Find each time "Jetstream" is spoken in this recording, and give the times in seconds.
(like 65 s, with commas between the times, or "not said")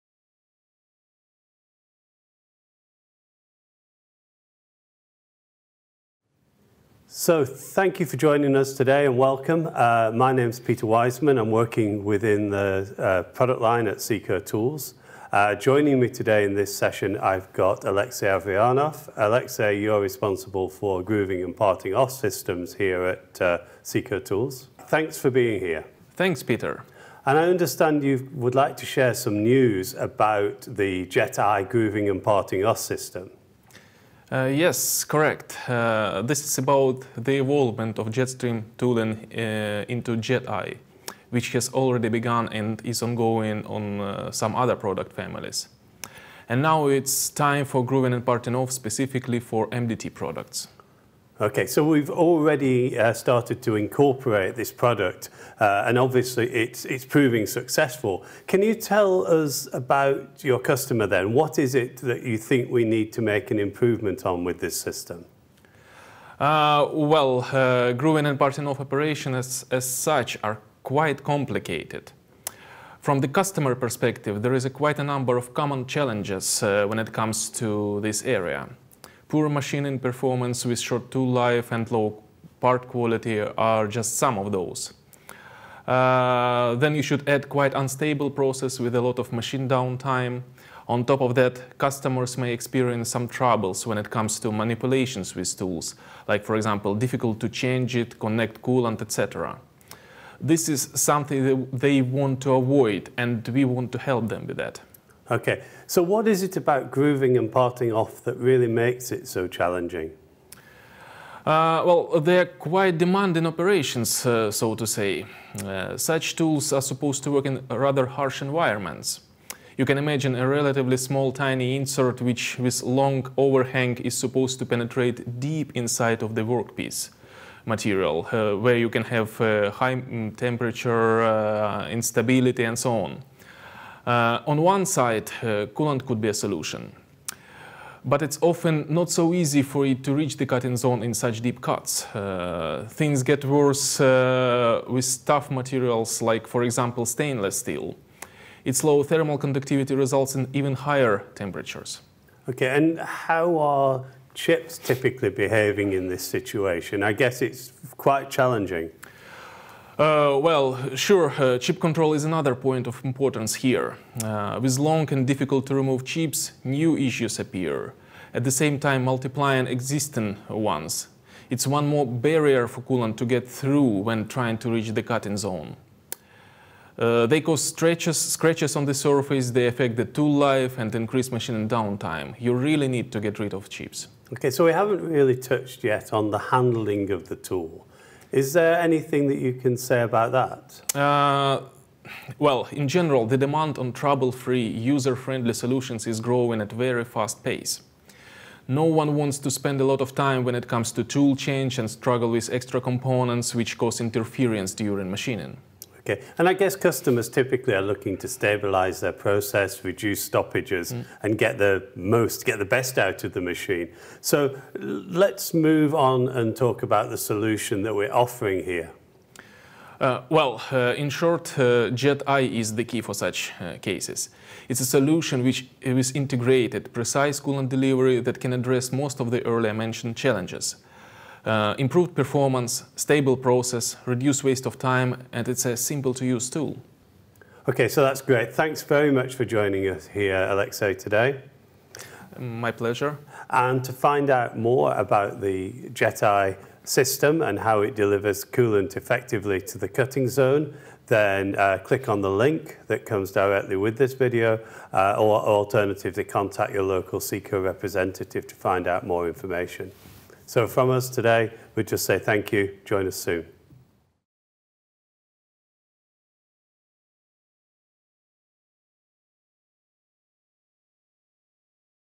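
38 s.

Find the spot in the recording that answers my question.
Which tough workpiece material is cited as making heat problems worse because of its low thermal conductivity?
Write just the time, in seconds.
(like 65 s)
147 s.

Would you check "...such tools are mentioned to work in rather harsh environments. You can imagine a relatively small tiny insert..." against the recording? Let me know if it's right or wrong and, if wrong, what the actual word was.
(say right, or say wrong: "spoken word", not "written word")
wrong: "supposed", not "mentioned".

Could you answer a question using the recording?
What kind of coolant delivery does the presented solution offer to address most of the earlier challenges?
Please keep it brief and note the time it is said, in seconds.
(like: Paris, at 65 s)
Integrated, precise coolant delivery, at 226 s.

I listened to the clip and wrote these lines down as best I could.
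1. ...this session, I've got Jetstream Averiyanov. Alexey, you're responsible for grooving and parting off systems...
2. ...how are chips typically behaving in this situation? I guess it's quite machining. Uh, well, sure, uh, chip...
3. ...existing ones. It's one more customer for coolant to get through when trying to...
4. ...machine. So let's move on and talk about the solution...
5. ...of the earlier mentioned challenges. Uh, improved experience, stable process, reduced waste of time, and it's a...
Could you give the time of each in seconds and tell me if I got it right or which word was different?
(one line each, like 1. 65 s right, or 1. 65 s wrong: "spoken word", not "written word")
1. 16 s wrong: "Alexey", not "Jetstream"
2. 152 s wrong: "challenging", not "machining"
3. 169 s wrong: "barrier", not "customer"
4. 213 s right
5. 229 s wrong: "performance", not "experience".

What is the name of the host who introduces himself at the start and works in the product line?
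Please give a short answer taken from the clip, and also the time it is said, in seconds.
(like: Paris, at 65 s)
Peter Wiseman, at 10 s.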